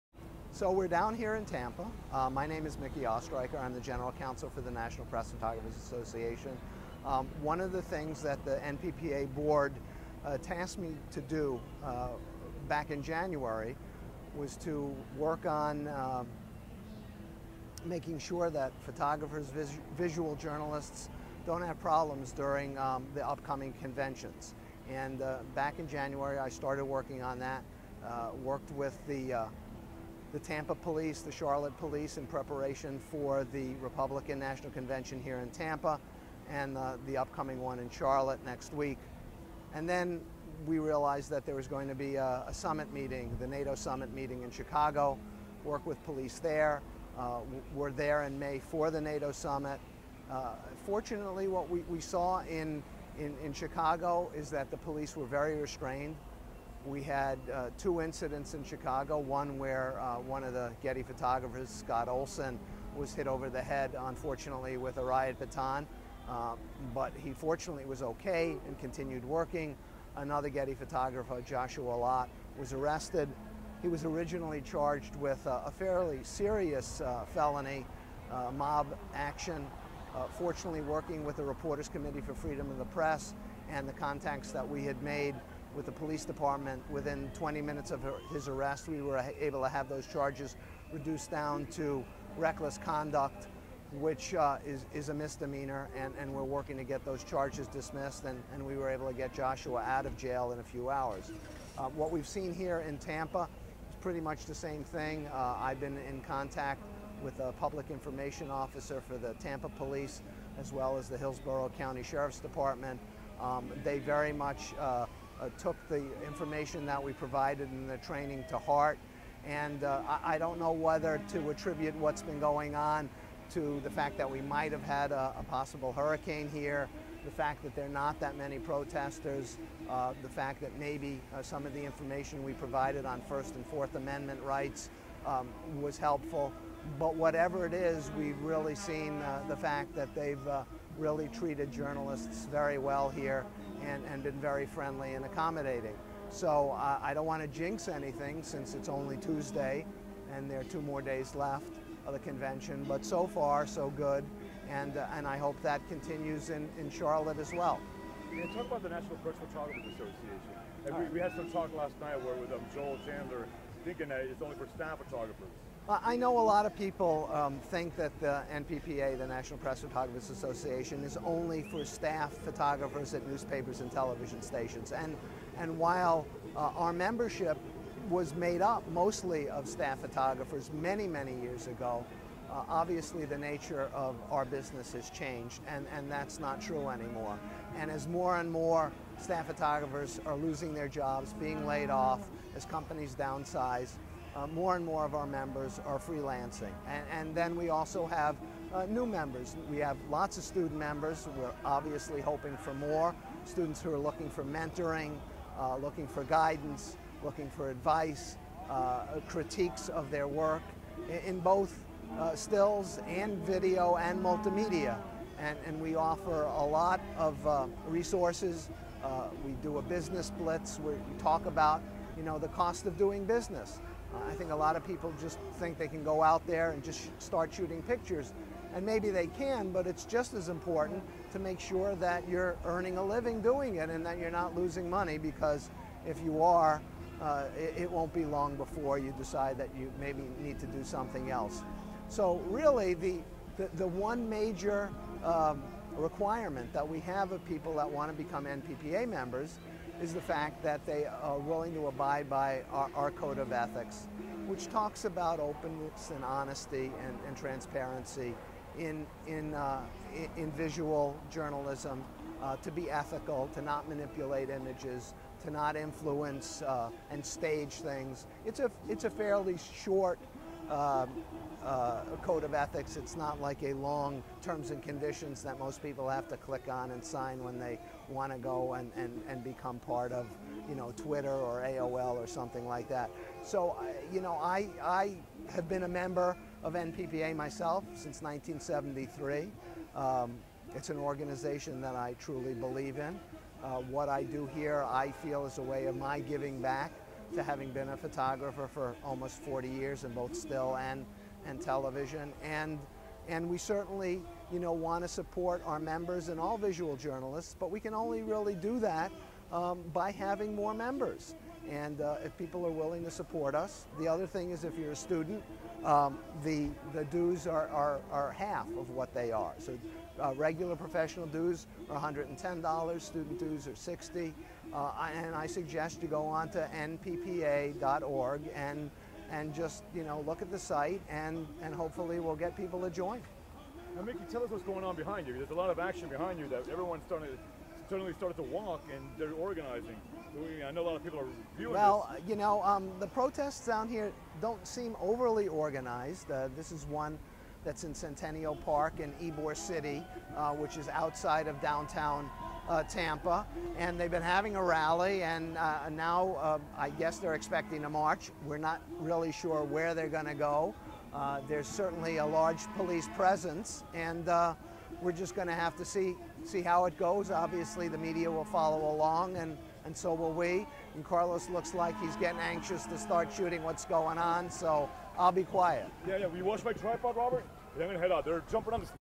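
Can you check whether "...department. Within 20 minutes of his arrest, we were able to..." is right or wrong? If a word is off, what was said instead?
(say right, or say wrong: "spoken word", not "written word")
right.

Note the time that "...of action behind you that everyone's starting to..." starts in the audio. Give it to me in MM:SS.
05:35.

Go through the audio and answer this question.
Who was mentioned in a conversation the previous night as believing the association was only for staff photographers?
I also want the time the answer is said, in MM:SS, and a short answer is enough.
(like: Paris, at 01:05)
Joel Chandler, at 02:42.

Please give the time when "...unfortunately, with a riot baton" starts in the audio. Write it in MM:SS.
01:04.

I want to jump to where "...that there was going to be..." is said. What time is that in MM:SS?
00:41.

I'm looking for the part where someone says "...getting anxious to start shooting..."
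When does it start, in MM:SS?
06:12.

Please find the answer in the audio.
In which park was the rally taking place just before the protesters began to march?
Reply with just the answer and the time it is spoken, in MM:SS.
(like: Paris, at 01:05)
Centennial Park, at 05:47.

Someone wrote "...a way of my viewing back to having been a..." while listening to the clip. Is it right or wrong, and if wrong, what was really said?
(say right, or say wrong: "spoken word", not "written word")
wrong: "giving", not "viewing".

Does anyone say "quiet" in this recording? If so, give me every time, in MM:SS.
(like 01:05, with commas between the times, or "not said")
06:15.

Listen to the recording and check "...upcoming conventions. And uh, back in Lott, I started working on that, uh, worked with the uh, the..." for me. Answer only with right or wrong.
wrong.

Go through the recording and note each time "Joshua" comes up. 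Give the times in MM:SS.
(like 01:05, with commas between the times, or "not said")
01:11, 01:39.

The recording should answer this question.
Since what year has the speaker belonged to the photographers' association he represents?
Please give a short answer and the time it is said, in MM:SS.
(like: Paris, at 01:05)
1973, at 04:48.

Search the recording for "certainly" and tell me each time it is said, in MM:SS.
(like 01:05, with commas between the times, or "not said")
05:03, 06:01.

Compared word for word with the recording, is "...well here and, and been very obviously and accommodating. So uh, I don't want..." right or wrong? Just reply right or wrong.
wrong.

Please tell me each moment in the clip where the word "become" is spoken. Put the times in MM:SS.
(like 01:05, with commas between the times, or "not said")
04:08, 04:39.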